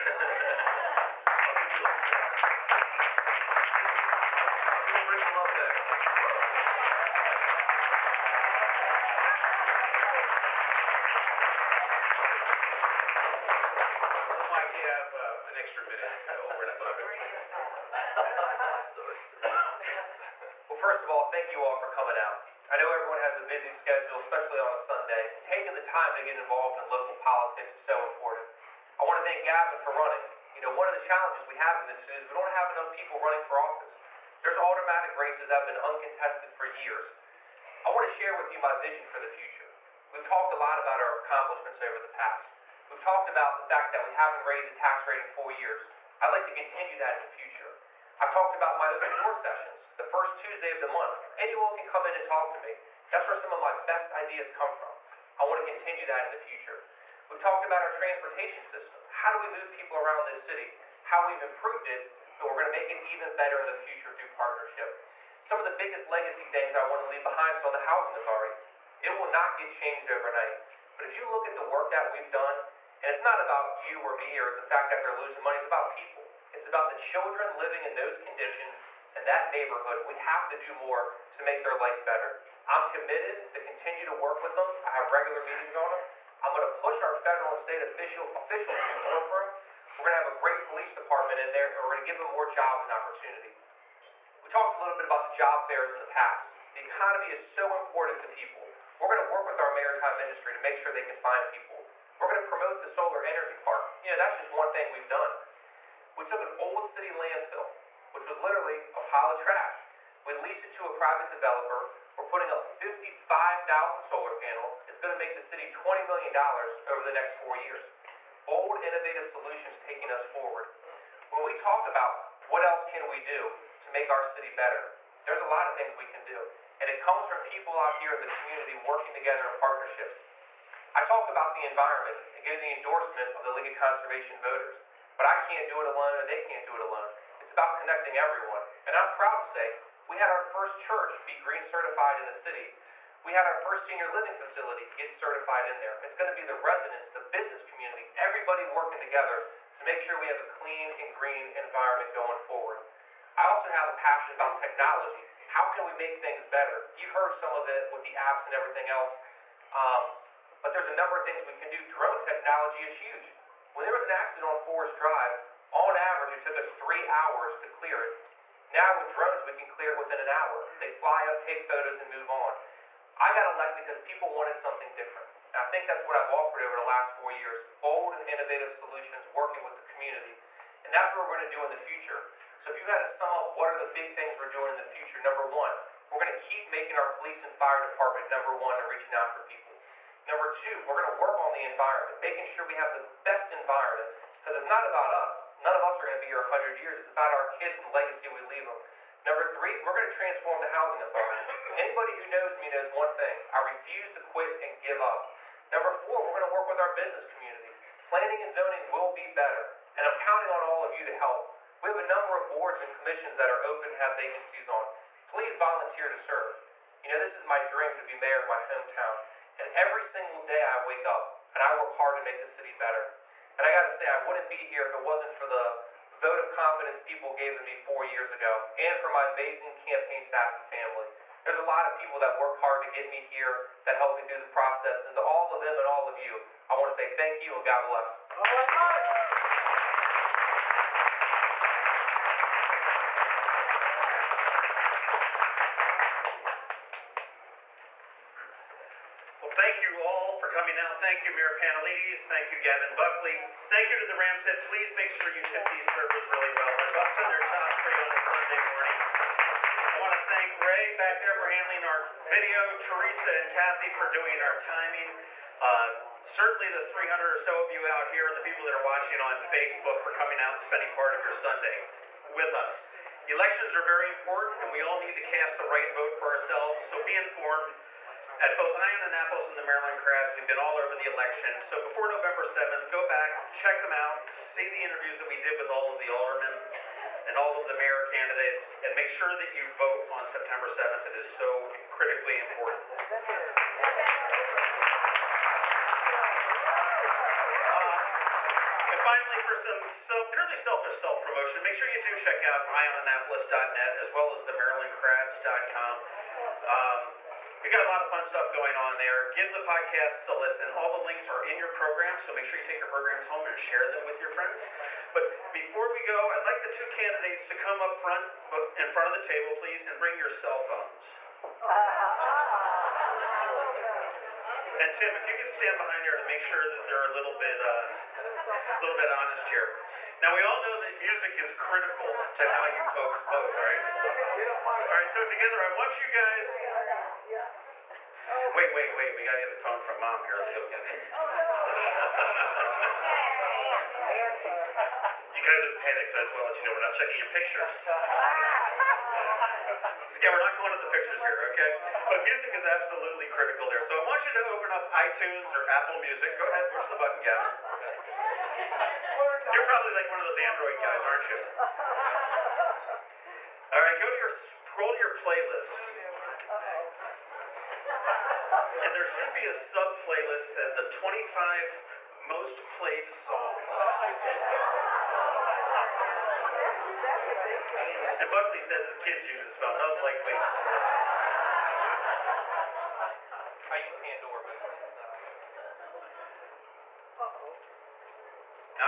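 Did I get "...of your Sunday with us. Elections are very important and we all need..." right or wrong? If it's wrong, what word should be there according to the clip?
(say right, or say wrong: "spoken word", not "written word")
right.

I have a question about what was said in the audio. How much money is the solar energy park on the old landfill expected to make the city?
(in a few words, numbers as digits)
$20 million.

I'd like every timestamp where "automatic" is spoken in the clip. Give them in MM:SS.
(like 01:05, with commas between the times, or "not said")
00:34.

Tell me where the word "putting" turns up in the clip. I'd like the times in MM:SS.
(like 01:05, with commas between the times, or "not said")
01:52.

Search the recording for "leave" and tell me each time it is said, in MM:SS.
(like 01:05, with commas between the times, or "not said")
01:07, 03:18.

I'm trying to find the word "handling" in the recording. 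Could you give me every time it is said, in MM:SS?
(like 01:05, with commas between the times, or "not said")
04:21.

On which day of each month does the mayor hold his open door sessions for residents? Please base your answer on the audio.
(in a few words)
First Tuesday.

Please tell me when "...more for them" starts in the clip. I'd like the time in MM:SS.
01:29.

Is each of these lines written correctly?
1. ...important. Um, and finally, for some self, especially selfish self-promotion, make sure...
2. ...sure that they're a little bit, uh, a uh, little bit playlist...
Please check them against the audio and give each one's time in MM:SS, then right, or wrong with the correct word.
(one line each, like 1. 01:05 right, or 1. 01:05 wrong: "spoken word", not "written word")
1. 04:52 wrong: "purely", not "especially"
2. 05:26 wrong: "honest", not "playlist".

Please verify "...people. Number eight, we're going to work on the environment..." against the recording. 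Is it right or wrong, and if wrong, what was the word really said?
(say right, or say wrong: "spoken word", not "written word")
wrong: "two", not "eight".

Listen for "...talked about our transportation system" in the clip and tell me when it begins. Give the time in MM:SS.
00:57.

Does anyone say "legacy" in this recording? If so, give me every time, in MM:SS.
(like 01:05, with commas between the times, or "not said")
01:06, 03:17.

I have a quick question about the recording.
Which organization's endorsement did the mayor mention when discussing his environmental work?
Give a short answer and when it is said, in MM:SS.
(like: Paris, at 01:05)
League of Conservation Voters, at 02:13.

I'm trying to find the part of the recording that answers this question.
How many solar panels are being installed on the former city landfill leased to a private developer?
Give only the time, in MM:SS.
01:52.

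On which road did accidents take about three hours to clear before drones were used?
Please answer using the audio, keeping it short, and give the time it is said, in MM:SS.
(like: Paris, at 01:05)
Forest Drive, at 02:44.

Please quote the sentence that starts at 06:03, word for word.
All right, go to your scroll to your playlist.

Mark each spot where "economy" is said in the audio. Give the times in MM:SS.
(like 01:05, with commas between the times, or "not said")
01:36.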